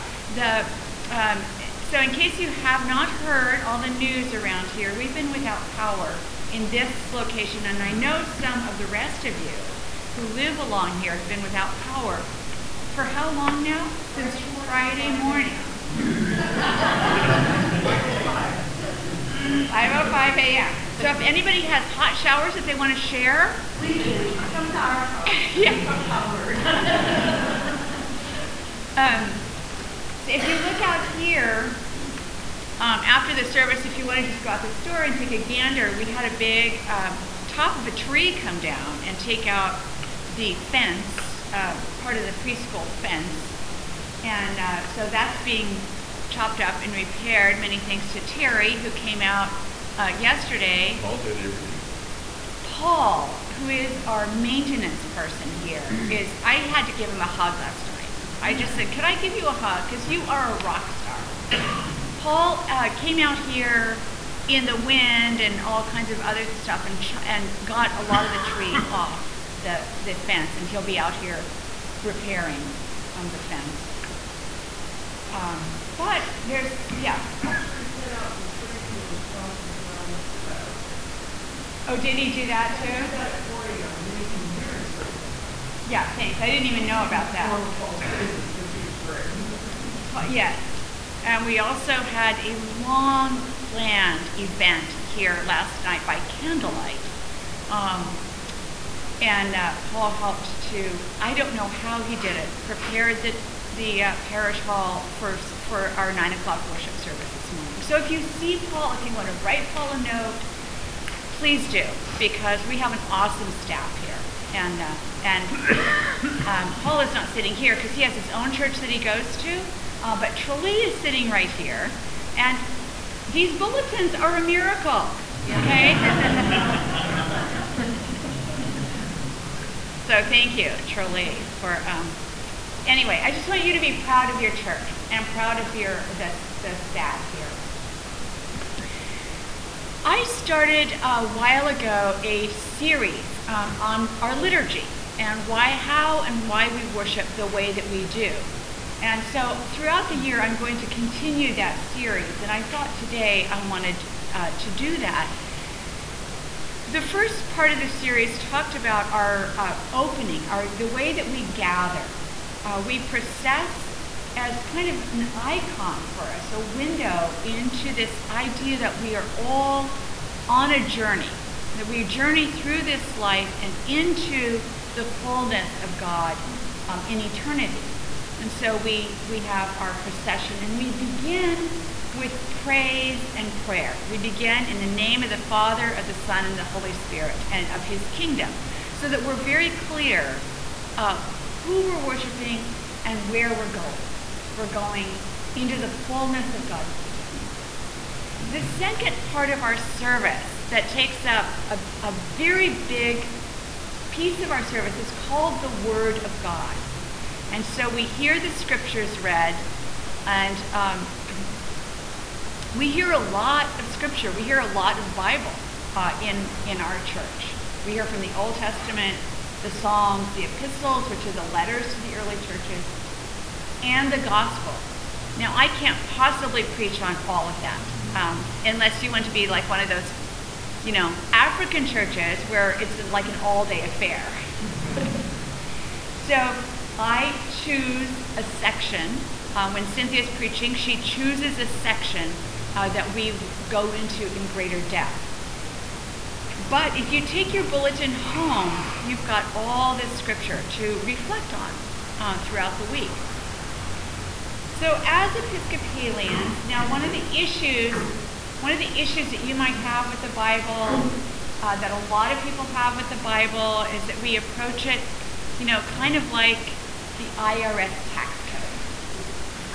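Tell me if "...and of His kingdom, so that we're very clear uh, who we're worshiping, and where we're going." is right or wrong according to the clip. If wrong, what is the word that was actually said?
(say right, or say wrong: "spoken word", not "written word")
right.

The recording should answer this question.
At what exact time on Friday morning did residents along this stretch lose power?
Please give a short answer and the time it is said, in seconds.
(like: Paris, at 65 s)
5:05 a.m., at 15 s.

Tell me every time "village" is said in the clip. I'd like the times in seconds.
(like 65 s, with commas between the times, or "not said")
not said.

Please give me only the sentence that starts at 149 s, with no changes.
And so throughout the year, I'm going to continue that series, and I thought today I wanted uh, to do that.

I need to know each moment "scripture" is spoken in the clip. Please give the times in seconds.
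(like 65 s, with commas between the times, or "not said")
208 s, 213 s, 250 s.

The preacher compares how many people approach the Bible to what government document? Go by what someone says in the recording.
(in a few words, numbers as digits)
IRS tax code.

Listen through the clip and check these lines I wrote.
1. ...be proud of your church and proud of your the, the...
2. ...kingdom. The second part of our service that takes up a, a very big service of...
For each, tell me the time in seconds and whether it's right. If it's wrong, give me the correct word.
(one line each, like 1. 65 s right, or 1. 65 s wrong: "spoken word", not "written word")
1. 133 s right
2. 197 s wrong: "piece", not "service".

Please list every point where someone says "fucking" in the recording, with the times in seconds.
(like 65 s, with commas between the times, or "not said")
not said.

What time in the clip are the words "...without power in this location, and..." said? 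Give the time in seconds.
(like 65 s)
5 s.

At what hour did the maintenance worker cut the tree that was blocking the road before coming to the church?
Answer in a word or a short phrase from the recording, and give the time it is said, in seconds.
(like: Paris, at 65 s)
4 a.m., at 83 s.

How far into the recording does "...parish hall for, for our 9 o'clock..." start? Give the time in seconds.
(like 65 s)
104 s.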